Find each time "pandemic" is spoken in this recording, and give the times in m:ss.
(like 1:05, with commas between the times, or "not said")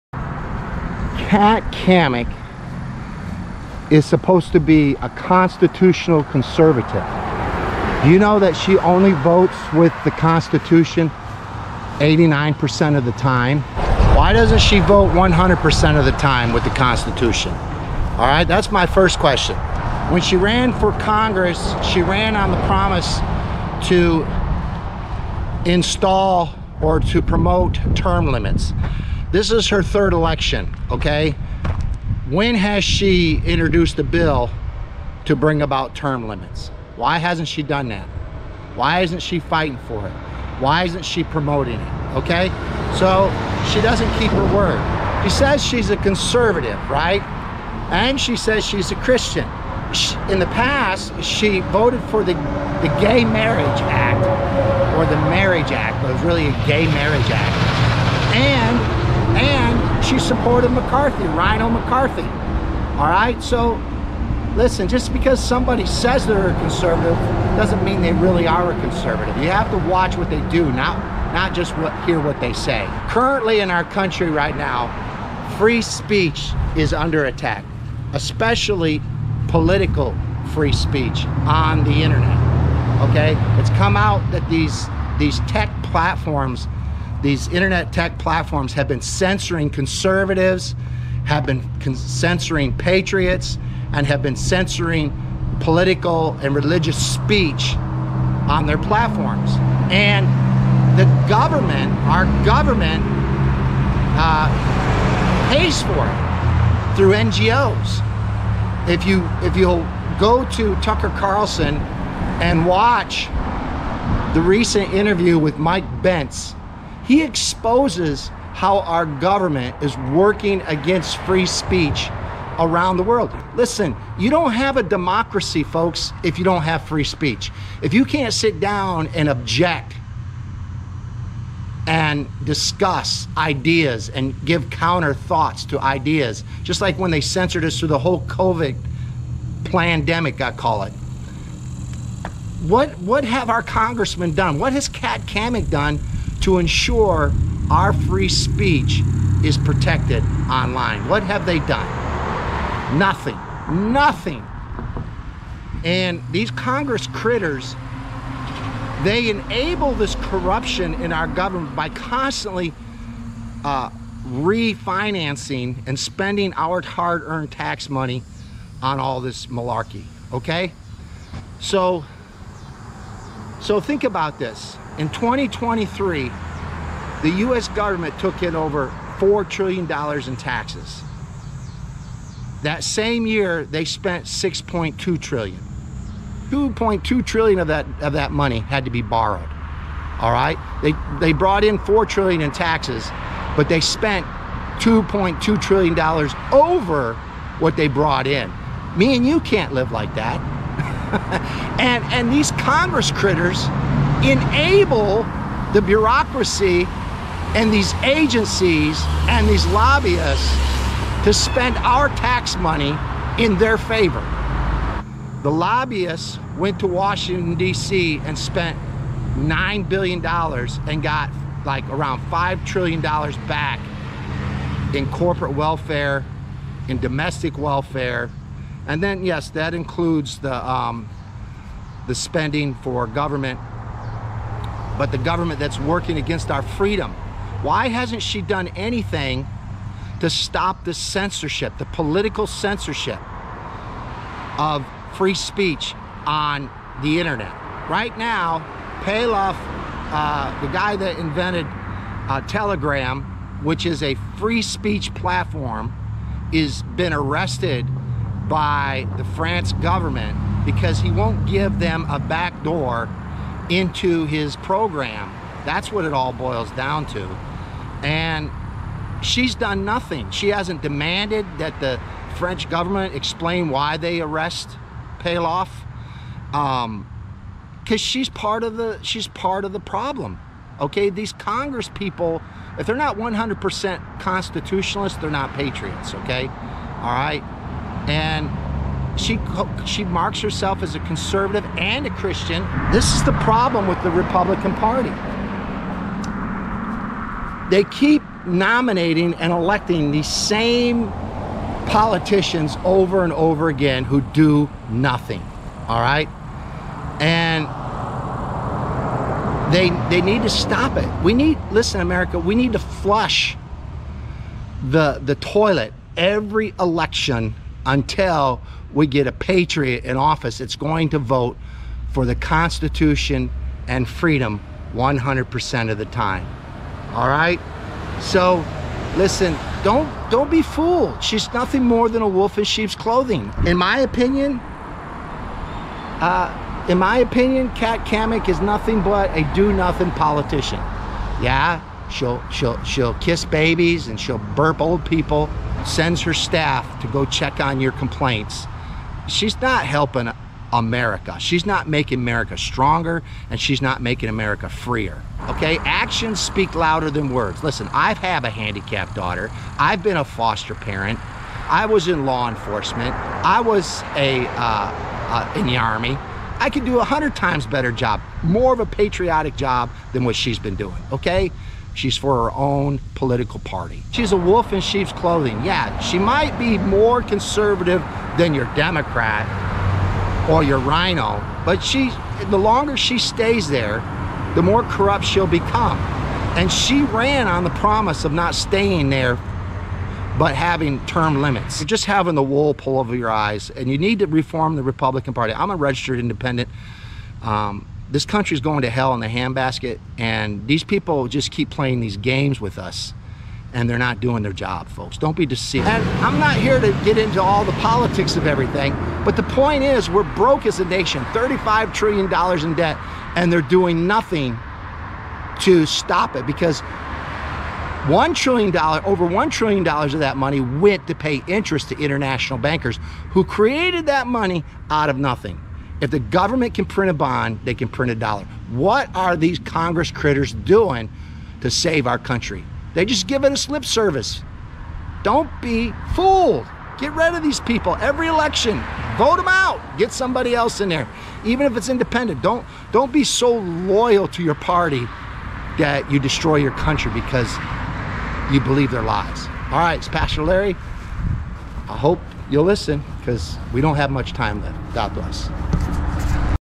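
2:19.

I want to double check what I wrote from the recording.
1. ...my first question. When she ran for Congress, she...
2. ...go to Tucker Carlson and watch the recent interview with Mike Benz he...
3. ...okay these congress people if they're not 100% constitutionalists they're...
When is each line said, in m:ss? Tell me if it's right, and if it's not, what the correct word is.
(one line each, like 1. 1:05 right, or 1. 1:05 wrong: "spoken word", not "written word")
1. 0:18 right
2. 1:50 right
3. 4:40 right.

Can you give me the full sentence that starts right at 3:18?
Me and you can't live like that.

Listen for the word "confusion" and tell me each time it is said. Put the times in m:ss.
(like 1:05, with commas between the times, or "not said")
not said.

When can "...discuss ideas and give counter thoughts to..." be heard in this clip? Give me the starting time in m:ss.
2:12.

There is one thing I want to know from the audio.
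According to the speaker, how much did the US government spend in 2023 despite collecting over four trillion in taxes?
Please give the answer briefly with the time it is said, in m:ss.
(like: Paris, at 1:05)
$6.2 trillion, at 3:04.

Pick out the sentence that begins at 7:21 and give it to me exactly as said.
Even if it's independent, don't don't be so loyal to your party that you destroy your country because you believe their lies.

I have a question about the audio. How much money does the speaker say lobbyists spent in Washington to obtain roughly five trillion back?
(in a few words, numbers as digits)
$9 billion.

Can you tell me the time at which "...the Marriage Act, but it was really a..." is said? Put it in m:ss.
0:55.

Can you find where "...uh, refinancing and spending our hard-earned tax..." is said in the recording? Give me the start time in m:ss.
2:43.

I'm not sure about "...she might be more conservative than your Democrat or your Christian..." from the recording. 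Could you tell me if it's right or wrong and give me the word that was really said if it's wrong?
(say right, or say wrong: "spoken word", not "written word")
wrong: "RINO", not "Christian".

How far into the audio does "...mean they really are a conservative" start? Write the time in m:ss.
1:07.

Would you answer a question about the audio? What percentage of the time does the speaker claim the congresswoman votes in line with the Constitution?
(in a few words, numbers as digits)
89%.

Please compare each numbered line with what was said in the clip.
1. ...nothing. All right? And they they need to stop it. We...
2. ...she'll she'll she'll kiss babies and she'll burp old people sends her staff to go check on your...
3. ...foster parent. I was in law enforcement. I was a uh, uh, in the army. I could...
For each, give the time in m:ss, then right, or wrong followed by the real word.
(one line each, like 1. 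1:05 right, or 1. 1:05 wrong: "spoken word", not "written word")
1. 5:04 right
2. 5:42 right
3. 6:00 right.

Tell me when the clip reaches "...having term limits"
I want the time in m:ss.
6:30.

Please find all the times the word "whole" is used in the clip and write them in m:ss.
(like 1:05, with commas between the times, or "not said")
2:17.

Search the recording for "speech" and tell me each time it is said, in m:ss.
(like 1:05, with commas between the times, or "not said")
1:15, 1:20, 1:37, 2:01, 2:07, 2:28, 4:05, 4:14.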